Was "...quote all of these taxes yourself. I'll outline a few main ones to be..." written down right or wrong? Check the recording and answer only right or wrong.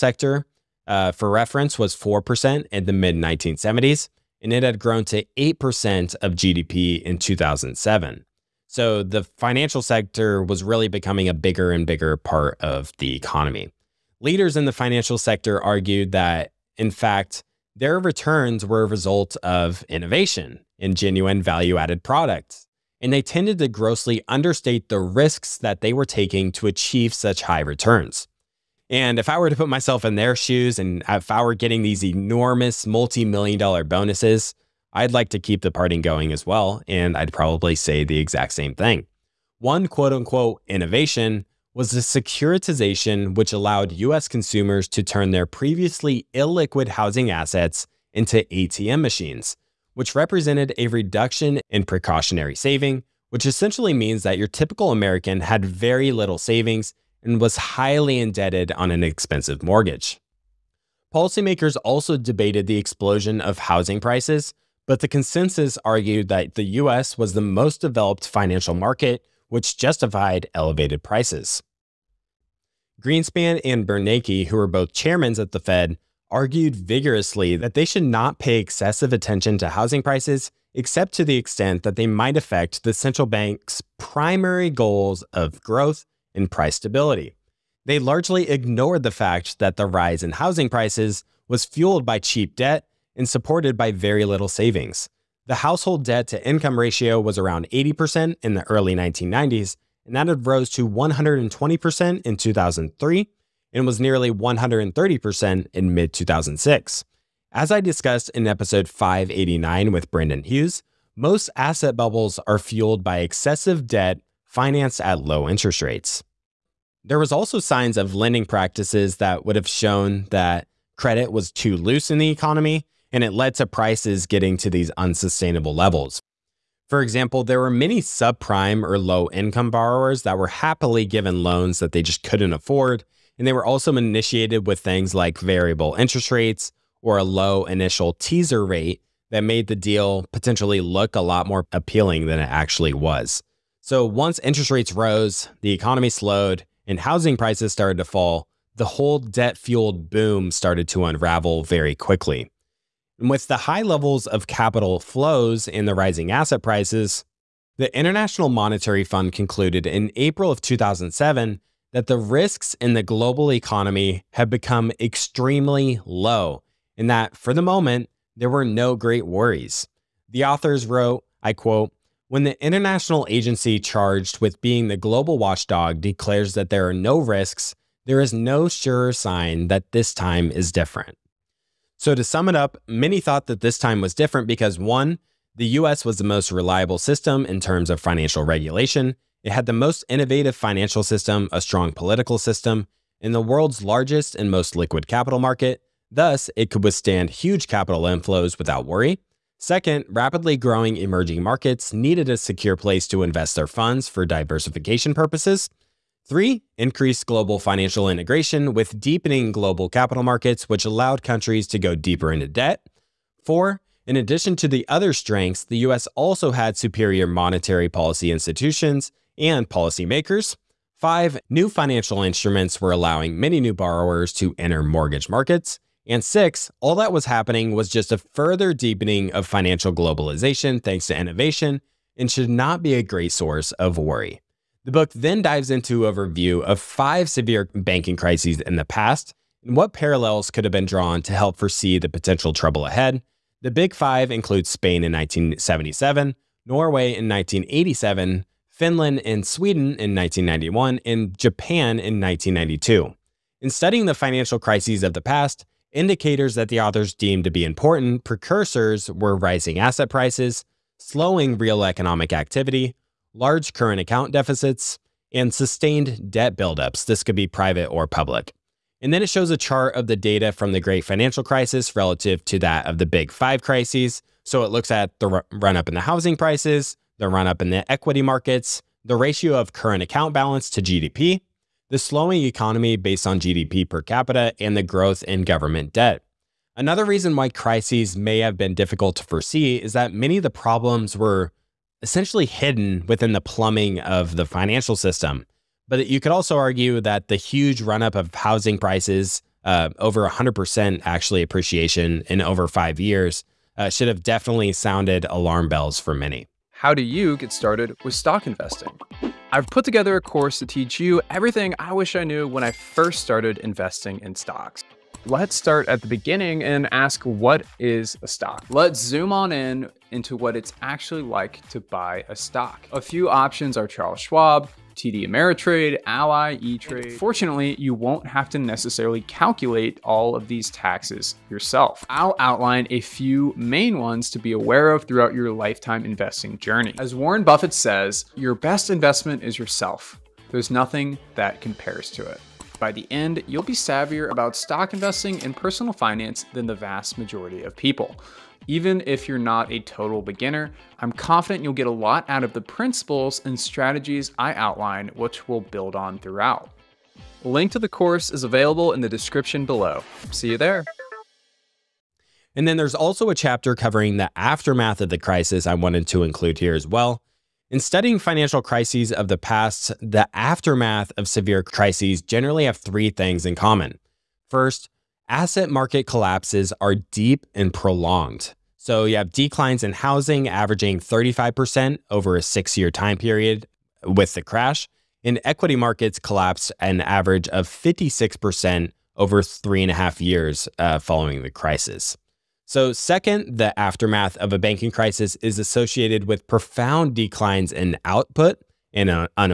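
wrong.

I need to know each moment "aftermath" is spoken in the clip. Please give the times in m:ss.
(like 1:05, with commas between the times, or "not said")
6:04, 6:10, 6:33.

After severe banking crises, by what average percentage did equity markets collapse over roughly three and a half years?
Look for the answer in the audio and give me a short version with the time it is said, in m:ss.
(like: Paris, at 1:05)
56%, at 6:27.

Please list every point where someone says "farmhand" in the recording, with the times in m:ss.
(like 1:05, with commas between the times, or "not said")
not said.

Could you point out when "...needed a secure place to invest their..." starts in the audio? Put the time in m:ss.
3:21.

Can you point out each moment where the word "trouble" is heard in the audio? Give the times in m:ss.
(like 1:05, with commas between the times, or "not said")
4:02.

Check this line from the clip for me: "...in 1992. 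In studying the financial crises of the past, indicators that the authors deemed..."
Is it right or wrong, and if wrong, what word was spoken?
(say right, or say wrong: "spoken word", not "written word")
right.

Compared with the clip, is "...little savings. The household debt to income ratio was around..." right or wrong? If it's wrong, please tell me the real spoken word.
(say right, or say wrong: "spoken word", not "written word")
right.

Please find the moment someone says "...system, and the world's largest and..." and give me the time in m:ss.
3:12.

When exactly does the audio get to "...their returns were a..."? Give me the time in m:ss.
0:17.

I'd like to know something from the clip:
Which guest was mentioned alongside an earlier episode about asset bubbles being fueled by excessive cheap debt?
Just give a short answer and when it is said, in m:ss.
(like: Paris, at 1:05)
Brendan Hughes, at 1:50.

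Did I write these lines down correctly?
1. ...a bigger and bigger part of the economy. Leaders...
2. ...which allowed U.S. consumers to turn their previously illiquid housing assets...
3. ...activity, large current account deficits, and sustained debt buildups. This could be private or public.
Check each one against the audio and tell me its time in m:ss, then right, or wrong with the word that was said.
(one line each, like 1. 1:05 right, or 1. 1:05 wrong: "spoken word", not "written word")
1. 0:11 right
2. 0:43 right
3. 4:22 right.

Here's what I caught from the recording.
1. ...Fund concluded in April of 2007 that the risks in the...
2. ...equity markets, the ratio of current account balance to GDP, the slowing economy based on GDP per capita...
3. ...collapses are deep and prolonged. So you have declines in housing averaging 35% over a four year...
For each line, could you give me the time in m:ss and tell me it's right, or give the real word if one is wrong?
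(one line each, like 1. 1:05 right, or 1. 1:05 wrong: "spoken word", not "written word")
1. 2:39 right
2. 4:37 right
3. 6:16 wrong: "six", not "four".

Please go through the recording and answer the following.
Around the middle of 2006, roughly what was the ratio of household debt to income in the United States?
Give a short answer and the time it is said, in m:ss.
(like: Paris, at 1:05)
nearly 130%, at 1:43.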